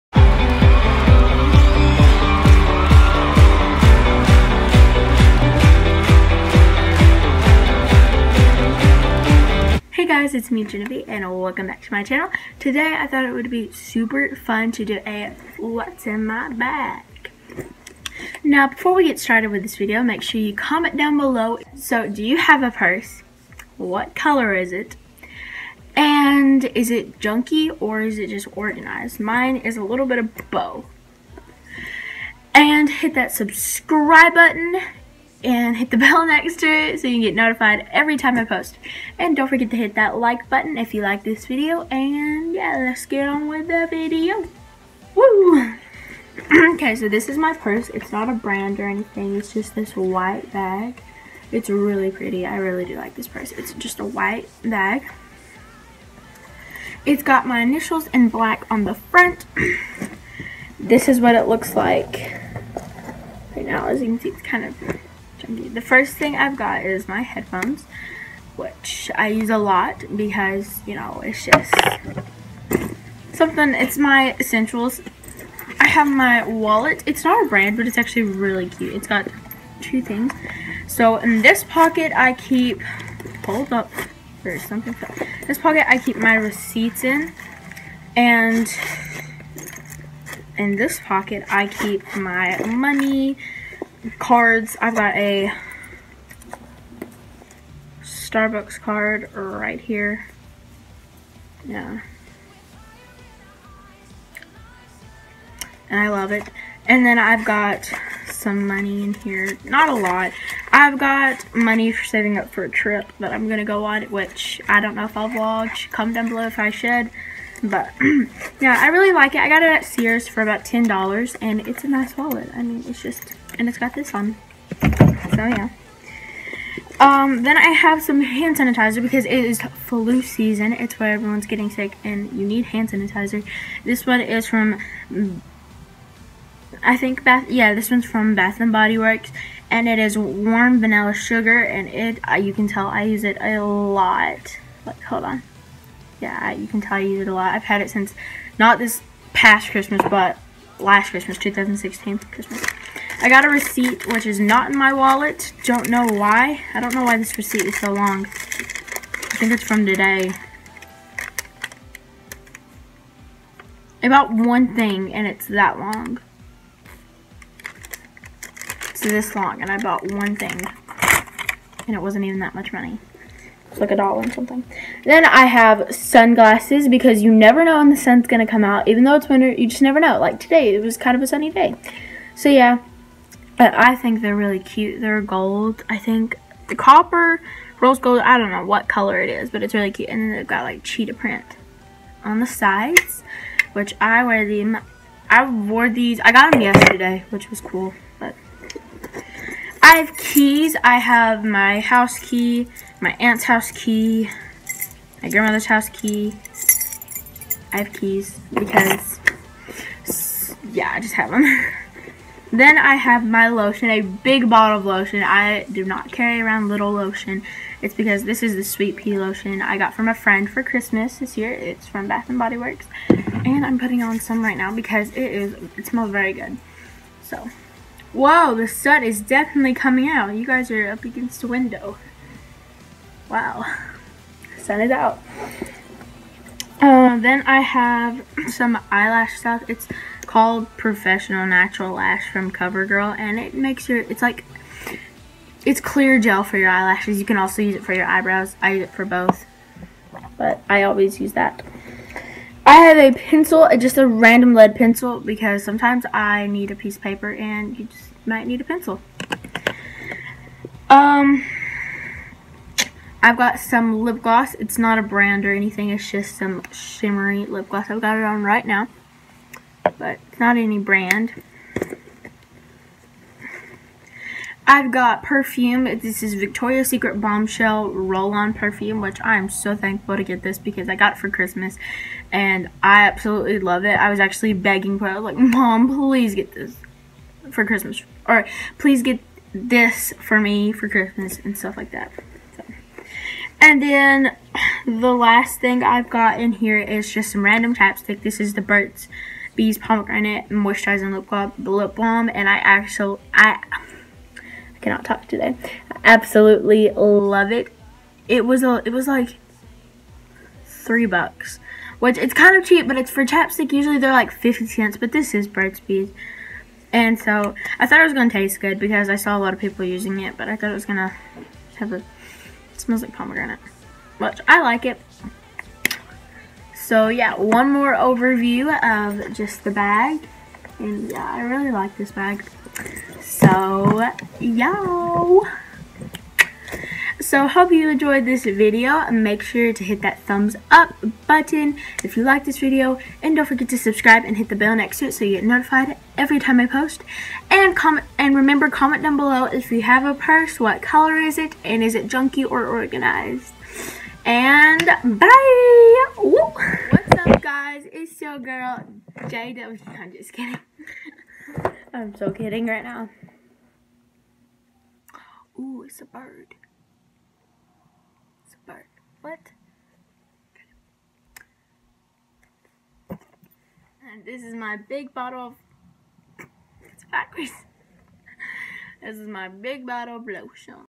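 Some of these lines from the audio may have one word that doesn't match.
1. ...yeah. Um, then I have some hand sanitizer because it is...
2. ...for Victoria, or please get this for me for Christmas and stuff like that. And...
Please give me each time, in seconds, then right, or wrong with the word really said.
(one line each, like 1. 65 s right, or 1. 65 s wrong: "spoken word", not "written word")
1. 125 s right
2. 287 s wrong: "Christmas", not "Victoria".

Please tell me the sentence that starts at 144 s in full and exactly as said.
Like, hold on yeah, you can tell I use it a lot.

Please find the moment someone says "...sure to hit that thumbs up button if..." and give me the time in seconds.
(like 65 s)
339 s.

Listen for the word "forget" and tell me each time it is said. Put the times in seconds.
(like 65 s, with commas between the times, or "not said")
39 s, 343 s.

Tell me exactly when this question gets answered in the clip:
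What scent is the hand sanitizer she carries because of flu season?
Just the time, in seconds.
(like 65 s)
140 s.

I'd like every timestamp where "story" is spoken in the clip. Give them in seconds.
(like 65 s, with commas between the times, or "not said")
not said.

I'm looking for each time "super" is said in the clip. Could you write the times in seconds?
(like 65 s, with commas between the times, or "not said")
13 s.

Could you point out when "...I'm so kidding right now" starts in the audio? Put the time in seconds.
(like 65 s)
361 s.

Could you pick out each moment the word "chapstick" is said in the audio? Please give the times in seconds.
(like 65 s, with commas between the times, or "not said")
297 s, 313 s.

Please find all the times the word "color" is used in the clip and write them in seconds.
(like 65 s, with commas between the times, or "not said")
24 s, 188 s, 350 s.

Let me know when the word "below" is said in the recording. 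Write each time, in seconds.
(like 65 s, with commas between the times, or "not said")
21 s, 116 s, 349 s.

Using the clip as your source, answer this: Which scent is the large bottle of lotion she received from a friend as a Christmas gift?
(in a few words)
Sweet Pea.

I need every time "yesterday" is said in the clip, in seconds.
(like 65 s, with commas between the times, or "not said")
196 s.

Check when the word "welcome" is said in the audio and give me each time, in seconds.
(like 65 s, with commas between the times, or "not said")
11 s.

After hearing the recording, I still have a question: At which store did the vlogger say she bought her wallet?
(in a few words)
Sears.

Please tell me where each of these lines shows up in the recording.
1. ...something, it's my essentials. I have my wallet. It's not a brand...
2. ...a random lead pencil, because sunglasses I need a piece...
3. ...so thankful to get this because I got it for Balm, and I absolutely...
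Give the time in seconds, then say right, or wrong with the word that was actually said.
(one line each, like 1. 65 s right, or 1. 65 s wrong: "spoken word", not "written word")
1. 73 s right
2. 253 s wrong: "sometimes", not "sunglasses"
3. 279 s wrong: "Christmas", not "Balm".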